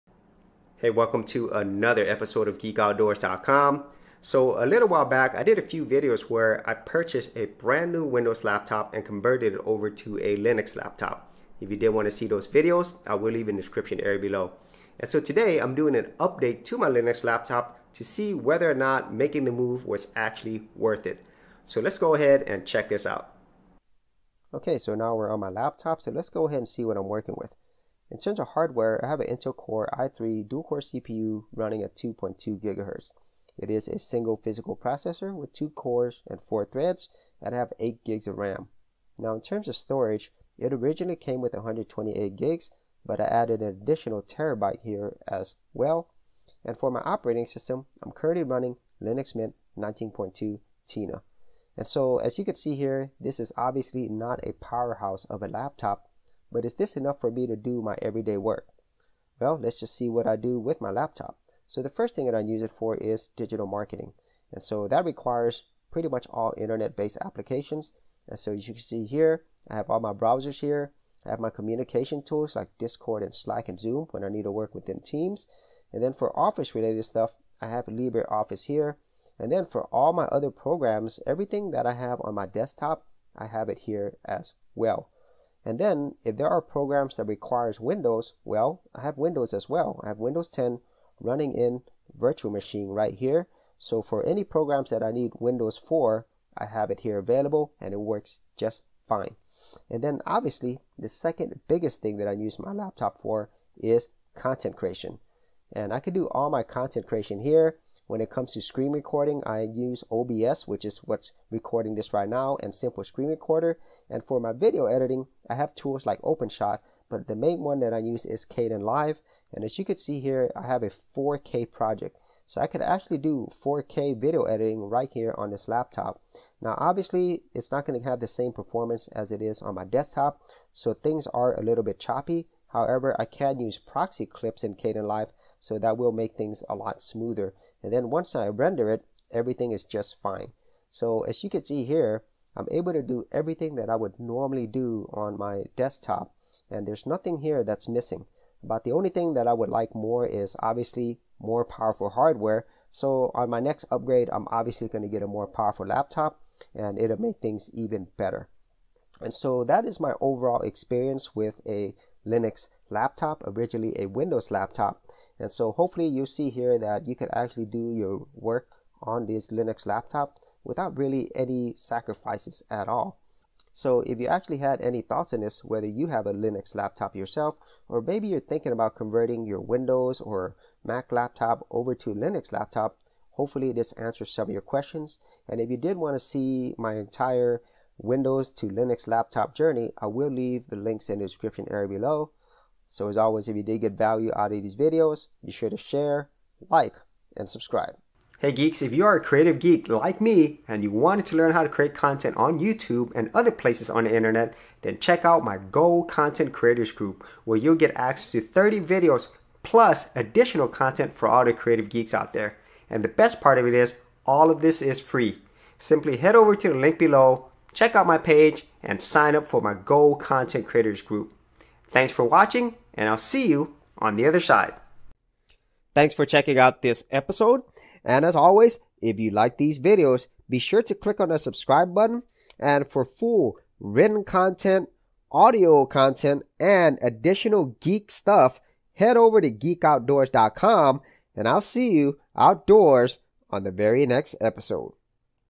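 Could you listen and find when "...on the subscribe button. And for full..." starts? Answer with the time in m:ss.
3:51.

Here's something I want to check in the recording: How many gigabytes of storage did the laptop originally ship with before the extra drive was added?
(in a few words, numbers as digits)
128.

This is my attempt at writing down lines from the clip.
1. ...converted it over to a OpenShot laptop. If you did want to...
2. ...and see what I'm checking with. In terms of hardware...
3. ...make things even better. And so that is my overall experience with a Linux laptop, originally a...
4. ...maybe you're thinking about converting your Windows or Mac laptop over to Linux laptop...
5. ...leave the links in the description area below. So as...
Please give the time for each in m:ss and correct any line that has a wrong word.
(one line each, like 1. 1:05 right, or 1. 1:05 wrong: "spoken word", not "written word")
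1. 0:09 wrong: "Linux", not "OpenShot"
2. 0:26 wrong: "working", not "checking"
3. 2:37 right
4. 2:58 right
5. 3:10 right.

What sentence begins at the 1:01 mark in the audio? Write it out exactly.
So the first thing that I use it for is digital marketing.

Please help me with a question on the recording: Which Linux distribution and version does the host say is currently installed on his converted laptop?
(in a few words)
Linux Mint 19.2.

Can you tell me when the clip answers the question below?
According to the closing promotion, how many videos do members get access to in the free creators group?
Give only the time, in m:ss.
3:28.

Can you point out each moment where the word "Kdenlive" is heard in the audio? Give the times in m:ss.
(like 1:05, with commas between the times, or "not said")
1:58, 2:14.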